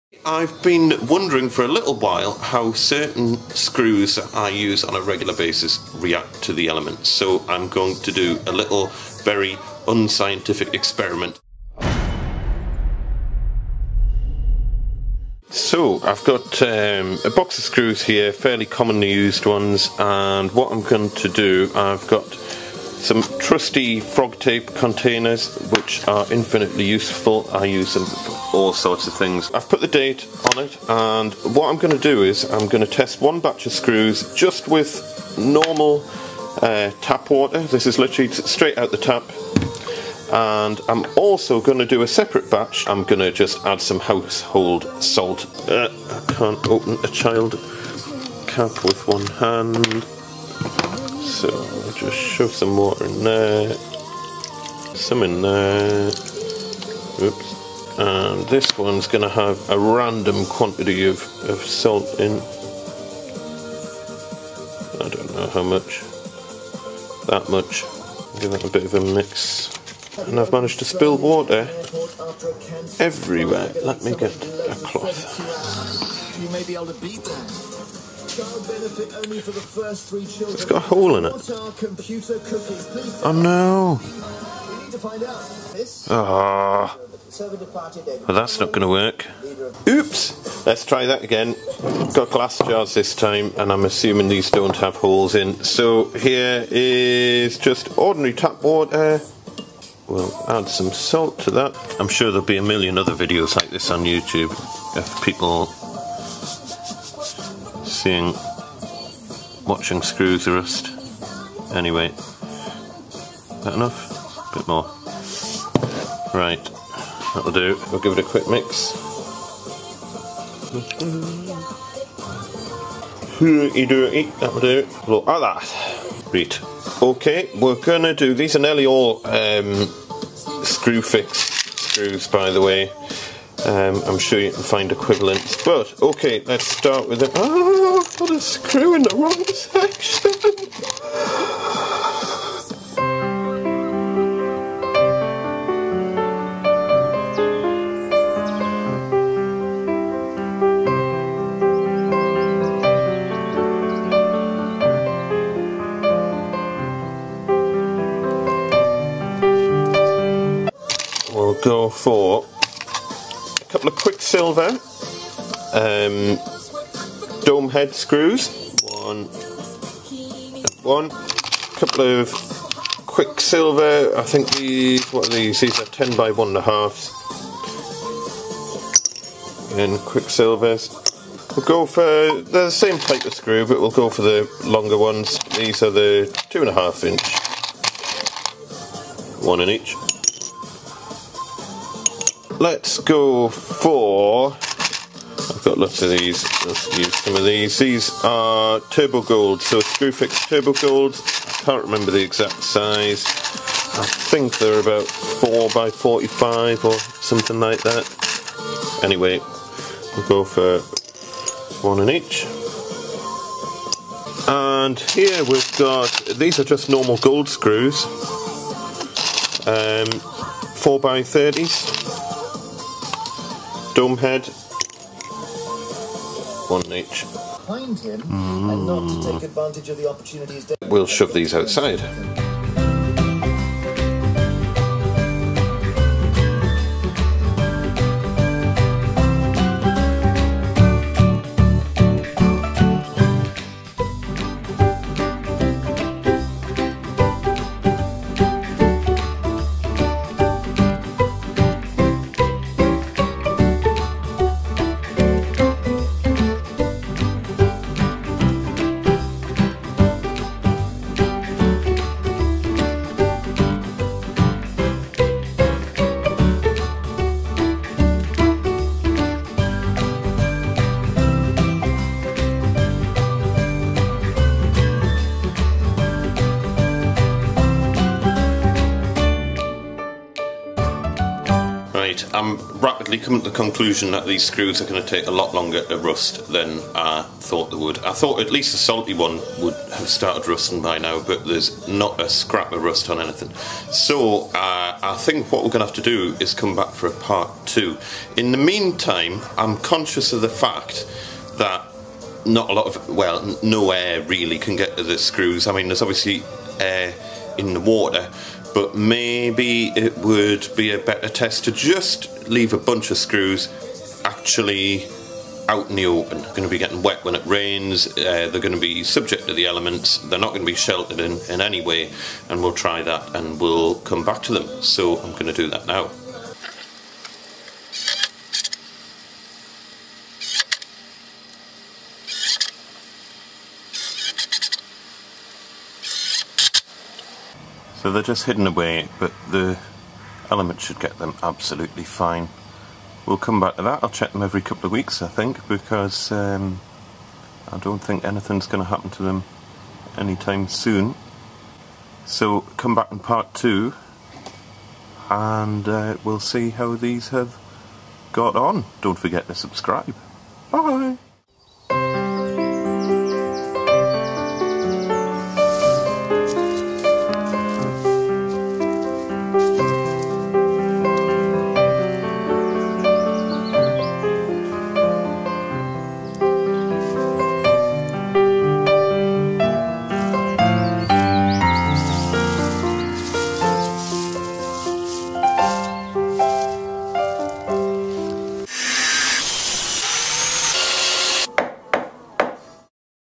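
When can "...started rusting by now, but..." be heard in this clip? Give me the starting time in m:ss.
4:50.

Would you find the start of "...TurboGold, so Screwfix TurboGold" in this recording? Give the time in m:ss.
3:18.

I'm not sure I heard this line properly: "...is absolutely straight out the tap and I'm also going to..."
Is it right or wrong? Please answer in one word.
wrong.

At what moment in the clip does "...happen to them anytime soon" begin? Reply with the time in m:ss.
5:48.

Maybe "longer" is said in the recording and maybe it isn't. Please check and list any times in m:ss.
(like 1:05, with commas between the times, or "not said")
3:04, 4:45.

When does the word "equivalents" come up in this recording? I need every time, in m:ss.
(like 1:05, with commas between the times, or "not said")
2:14.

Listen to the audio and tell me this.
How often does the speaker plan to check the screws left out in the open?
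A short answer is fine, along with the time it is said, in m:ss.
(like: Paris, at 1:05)
Every couple of weeks, at 5:44.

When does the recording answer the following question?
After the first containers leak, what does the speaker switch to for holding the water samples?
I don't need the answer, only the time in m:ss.
1:32.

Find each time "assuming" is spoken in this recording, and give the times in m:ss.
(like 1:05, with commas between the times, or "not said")
1:33.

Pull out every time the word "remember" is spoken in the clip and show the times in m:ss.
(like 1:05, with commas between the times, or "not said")
3:21.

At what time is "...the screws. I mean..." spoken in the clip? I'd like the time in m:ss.
5:05.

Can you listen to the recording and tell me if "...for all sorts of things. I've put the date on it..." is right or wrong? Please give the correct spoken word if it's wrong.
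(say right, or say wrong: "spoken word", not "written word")
right.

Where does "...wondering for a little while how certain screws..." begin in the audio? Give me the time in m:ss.
0:01.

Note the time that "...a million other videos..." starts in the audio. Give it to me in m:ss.
1:42.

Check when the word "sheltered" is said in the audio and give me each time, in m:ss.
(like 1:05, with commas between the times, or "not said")
5:20.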